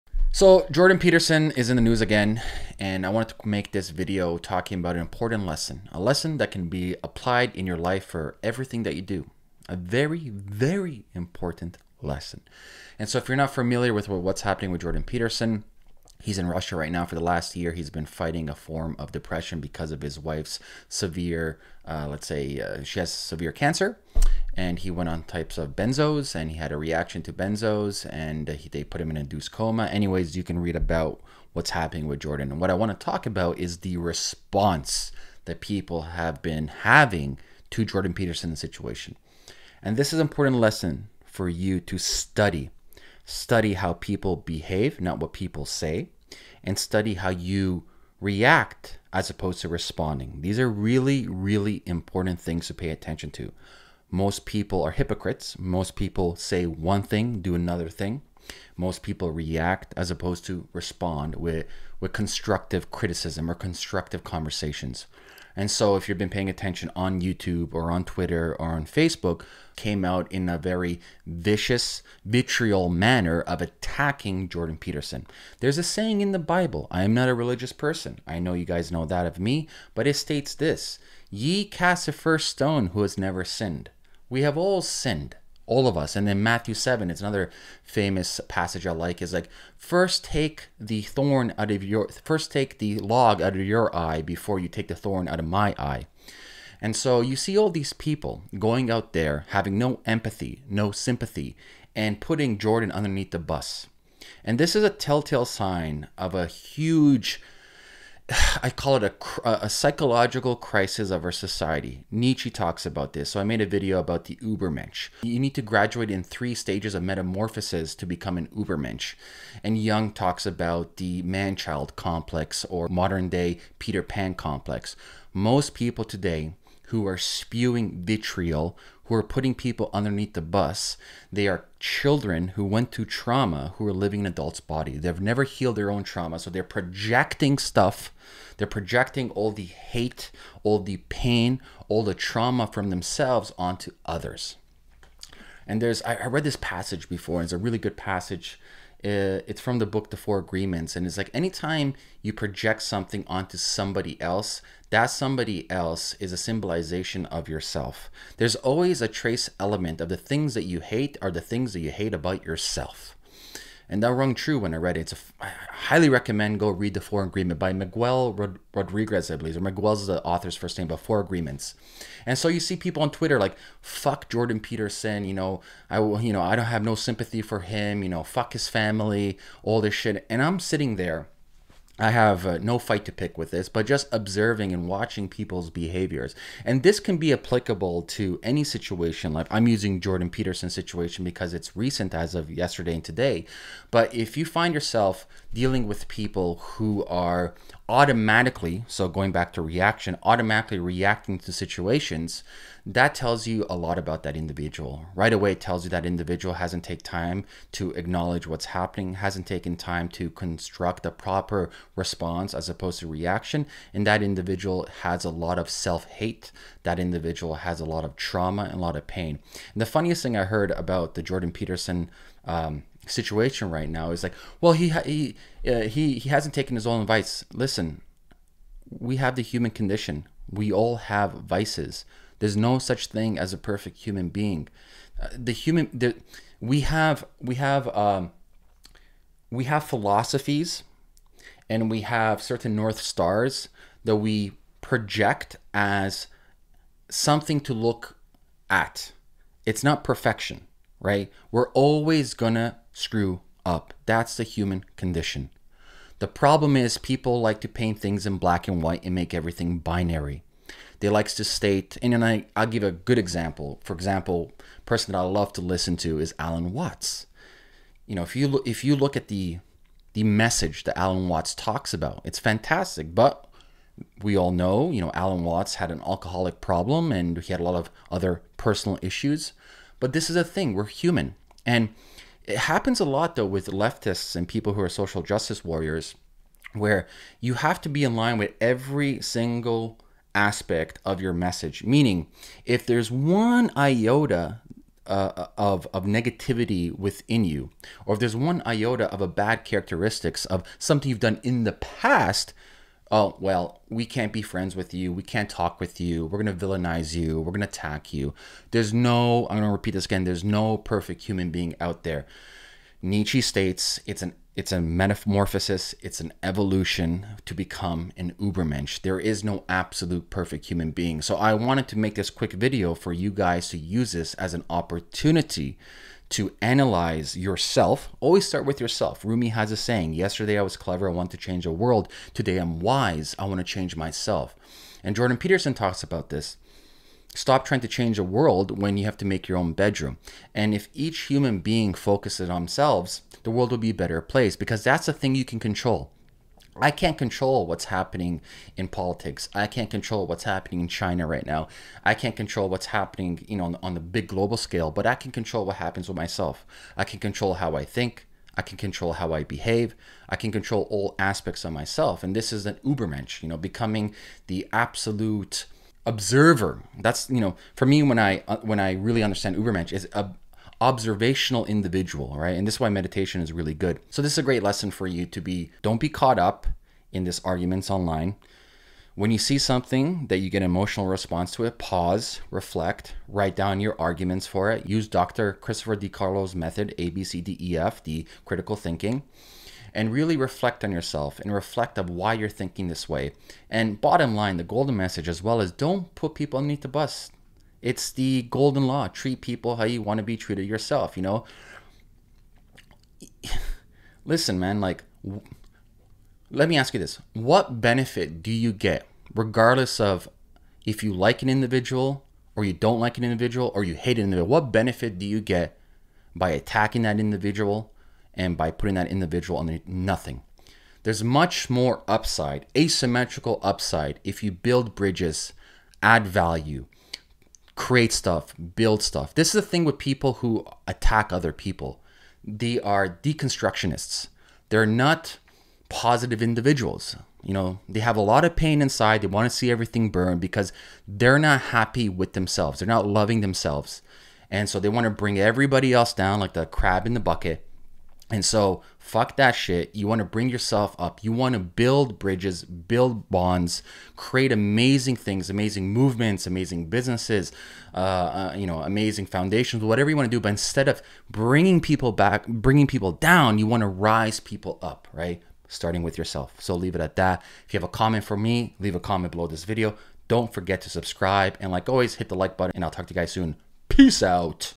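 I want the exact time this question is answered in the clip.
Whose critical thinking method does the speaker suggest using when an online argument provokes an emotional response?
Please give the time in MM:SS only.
06:25.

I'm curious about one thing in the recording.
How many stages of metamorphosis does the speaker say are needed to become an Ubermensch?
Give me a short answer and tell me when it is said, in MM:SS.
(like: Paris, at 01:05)
3, at 01:56.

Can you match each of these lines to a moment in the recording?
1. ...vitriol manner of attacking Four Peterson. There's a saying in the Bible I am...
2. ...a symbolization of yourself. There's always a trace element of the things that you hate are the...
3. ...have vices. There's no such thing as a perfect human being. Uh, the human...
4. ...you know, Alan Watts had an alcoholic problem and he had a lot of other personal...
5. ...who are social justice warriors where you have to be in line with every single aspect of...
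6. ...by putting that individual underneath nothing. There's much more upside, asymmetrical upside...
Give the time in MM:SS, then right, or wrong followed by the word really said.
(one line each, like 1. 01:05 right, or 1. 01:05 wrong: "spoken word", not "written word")
1. 01:12 wrong: "Jordan", not "Four"
2. 02:36 right
3. 03:50 right
4. 04:34 right
5. 04:44 right
6. 06:58 right.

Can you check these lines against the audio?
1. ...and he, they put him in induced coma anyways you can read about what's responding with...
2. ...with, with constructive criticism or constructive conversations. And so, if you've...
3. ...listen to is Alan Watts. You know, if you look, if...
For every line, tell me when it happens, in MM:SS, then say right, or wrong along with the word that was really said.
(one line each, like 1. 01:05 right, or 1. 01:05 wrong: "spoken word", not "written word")
1. 00:28 wrong: "happening", not "responding"
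2. 01:01 right
3. 04:25 right.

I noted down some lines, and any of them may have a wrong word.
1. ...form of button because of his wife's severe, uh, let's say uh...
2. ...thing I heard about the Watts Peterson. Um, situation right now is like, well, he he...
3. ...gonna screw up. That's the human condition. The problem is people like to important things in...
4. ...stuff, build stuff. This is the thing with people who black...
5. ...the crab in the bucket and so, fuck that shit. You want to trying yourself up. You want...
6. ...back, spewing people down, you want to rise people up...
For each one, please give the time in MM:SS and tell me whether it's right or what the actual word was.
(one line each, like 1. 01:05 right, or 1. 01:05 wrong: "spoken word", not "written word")
1. 00:18 wrong: "depression", not "button"
2. 03:40 wrong: "Jordan", not "Watts"
3. 04:12 wrong: "paint", not "important"
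4. 07:08 wrong: "attack", not "black"
5. 07:26 wrong: "bring", not "trying"
6. 07:42 wrong: "bringing", not "spewing".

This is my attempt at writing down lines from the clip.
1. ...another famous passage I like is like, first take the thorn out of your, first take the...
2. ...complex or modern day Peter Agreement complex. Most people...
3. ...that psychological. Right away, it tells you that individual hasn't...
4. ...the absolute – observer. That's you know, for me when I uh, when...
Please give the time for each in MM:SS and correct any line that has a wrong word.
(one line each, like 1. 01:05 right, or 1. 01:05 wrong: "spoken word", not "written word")
1. 01:27 right
2. 02:01 wrong: "Pan", not "Agreement"
3. 03:24 wrong: "individual", not "psychological"
4. 06:04 right.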